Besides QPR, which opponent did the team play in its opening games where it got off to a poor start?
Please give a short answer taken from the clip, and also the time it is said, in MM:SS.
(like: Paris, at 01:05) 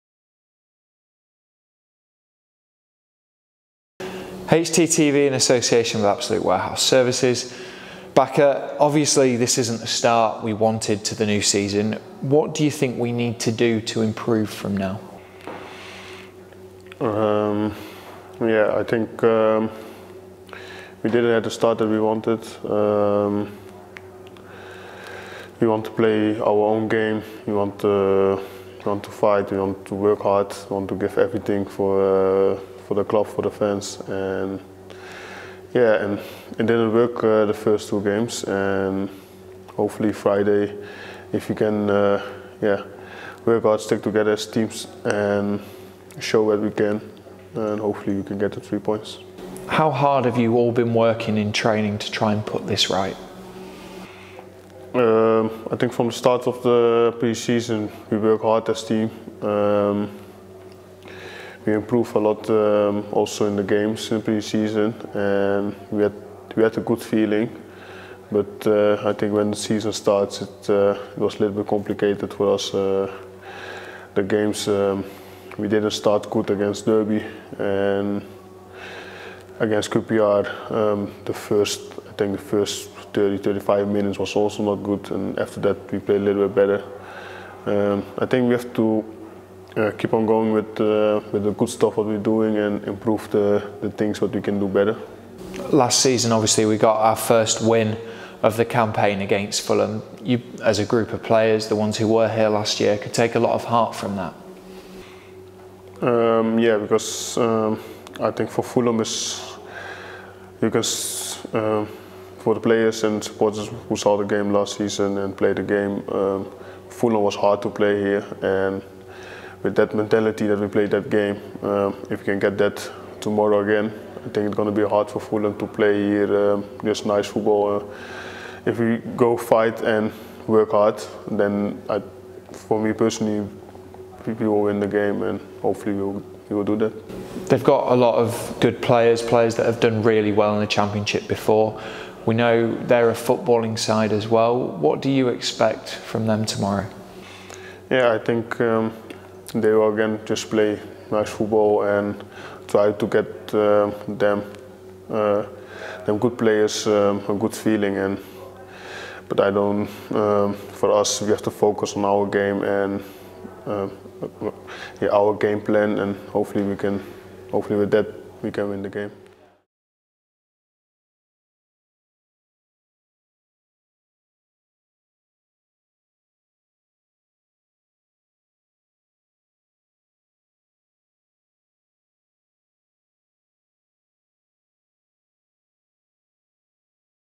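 Derby, at 01:16.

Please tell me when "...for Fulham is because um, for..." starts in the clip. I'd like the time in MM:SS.
01:48.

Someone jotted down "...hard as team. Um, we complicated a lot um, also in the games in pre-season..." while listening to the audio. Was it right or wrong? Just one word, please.
wrong.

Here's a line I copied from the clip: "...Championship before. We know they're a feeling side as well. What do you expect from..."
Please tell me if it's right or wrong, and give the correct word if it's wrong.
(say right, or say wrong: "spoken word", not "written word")
wrong: "footballing", not "feeling".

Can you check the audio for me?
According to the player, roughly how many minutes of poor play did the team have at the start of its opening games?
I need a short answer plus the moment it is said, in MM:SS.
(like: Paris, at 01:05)
30-35, at 01:23.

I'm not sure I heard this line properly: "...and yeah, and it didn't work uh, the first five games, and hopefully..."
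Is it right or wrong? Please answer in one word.
wrong.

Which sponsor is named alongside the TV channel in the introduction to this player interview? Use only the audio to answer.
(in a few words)
Absolute Warehouse Services.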